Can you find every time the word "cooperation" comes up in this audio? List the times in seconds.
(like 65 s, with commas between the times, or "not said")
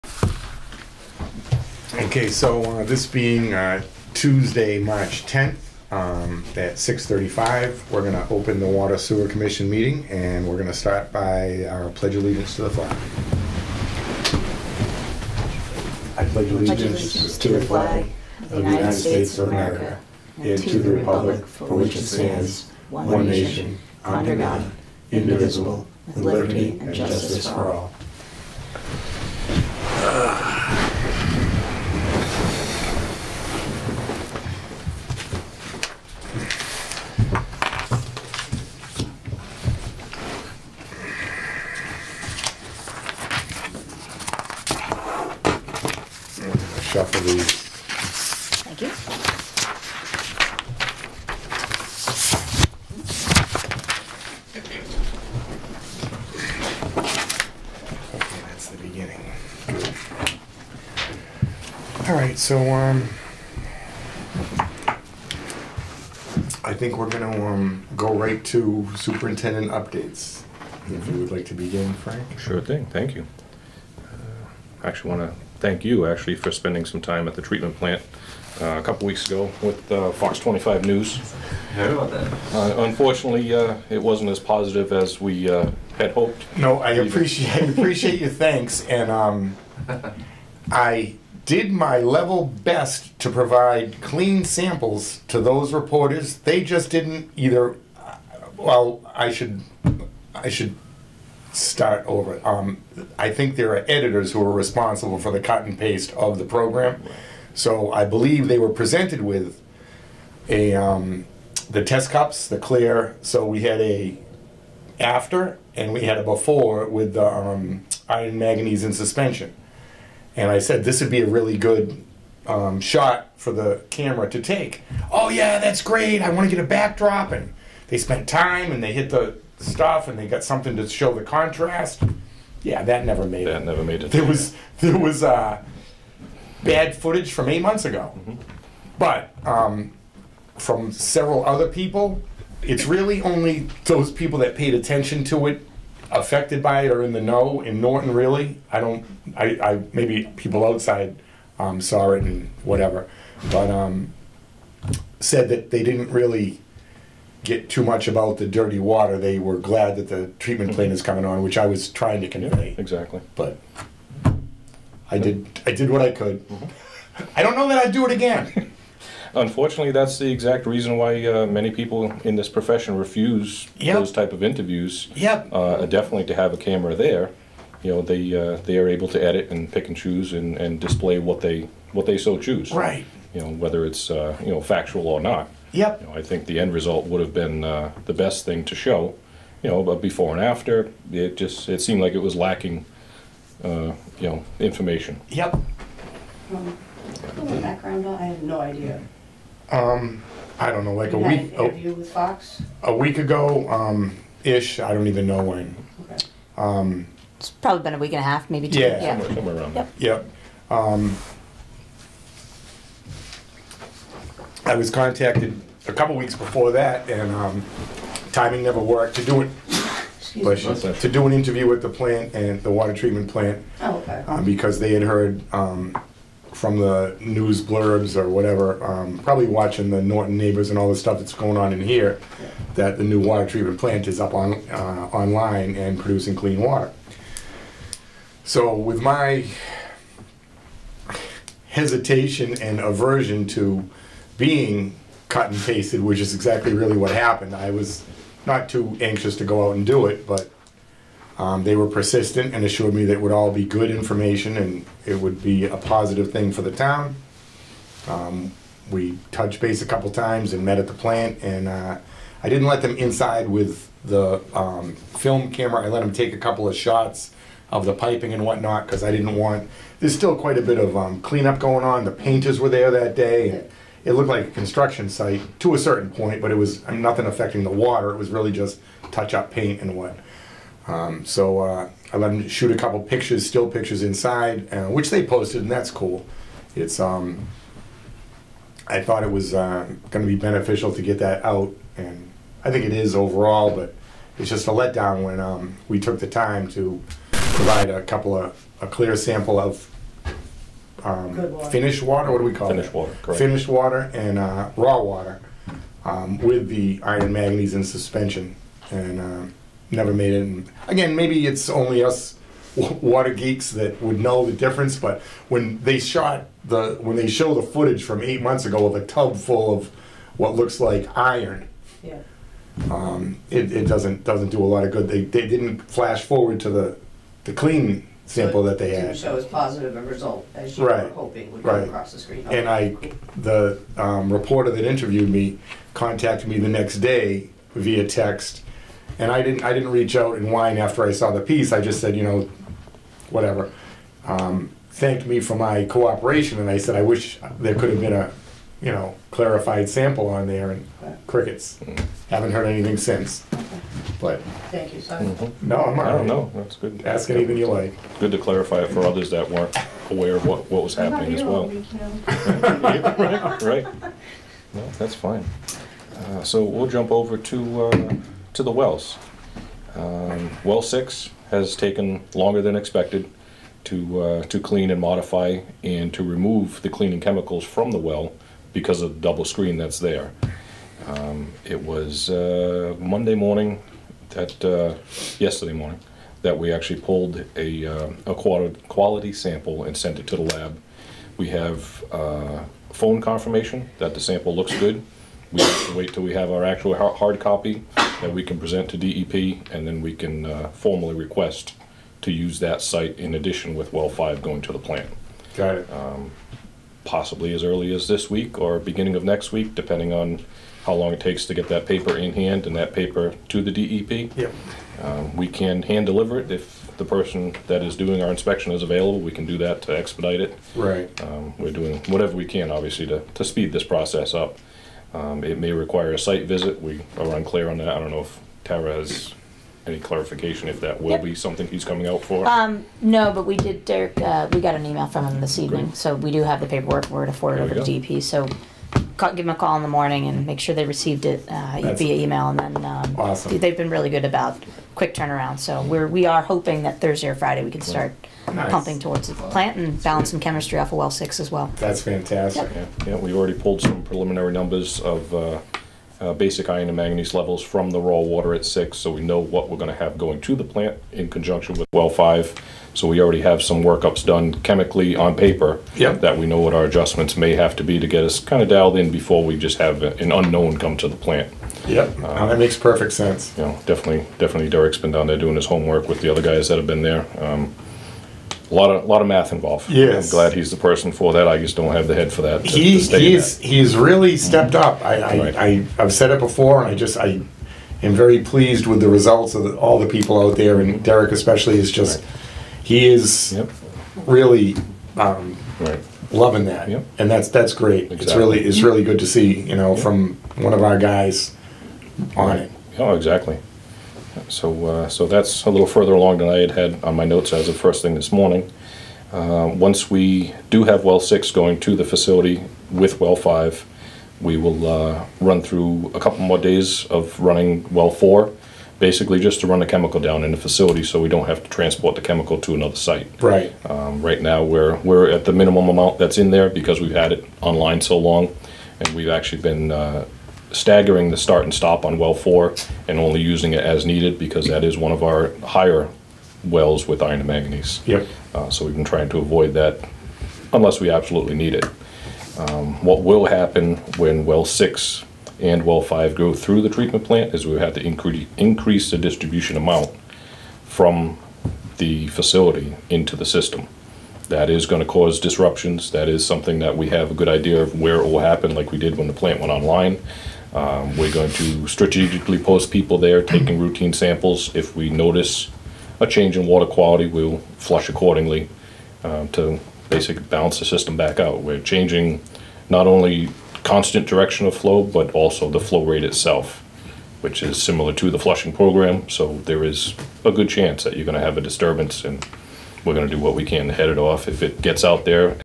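345 s.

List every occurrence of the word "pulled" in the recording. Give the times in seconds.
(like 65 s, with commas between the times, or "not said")
386 s, 453 s.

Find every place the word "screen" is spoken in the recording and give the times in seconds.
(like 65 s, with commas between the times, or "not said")
332 s, 379 s.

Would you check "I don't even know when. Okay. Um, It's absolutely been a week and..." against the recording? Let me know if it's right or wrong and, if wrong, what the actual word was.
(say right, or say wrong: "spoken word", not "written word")
wrong: "probably", not "absolutely".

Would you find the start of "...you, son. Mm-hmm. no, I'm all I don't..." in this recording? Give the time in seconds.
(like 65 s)
354 s.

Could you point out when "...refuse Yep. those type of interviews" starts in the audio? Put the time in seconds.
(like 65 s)
172 s.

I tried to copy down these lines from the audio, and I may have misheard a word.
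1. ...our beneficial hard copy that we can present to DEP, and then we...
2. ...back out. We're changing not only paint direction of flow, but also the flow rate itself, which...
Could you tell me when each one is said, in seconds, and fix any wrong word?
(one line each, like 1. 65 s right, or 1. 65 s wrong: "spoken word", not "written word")
1. 396 s wrong: "actual", not "beneficial"
2. 571 s wrong: "constant", not "paint".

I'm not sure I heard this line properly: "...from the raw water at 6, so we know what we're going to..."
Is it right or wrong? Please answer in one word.
right.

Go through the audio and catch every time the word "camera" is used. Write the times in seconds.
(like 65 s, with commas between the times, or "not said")
123 s, 176 s, 265 s.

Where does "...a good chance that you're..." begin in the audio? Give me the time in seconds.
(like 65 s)
580 s.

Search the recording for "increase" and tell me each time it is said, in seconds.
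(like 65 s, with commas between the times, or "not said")
548 s.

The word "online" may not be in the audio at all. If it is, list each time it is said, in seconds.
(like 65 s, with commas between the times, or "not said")
235 s, 527 s, 559 s.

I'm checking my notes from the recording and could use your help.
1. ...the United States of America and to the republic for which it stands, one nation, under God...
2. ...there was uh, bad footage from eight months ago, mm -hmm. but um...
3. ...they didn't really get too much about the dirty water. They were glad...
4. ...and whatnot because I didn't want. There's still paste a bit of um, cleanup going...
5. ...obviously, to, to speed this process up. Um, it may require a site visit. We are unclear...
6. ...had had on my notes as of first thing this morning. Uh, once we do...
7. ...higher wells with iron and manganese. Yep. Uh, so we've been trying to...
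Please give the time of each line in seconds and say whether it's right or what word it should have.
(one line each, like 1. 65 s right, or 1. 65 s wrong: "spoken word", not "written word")
1. 18 s right
2. 134 s right
3. 155 s right
4. 268 s wrong: "quite", not "paste"
5. 422 s right
6. 506 s right
7. 535 s right.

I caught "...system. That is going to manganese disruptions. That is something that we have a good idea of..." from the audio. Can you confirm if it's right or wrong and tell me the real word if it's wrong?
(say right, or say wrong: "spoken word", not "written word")
wrong: "cause", not "manganese".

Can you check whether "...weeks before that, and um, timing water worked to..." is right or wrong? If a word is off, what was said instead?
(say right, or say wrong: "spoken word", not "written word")
wrong: "never", not "water".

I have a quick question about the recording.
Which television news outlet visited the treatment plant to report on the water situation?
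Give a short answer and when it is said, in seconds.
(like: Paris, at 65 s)
Fox 25 News, at 80 s.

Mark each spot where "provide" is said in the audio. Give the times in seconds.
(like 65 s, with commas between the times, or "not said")
93 s, 297 s.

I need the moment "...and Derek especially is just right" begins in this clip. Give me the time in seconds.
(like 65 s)
490 s.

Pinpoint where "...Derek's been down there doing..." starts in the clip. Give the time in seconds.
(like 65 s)
474 s.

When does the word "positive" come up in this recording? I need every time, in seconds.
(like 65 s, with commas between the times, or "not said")
84 s, 255 s, 329 s.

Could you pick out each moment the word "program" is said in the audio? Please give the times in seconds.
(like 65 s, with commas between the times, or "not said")
106 s, 578 s.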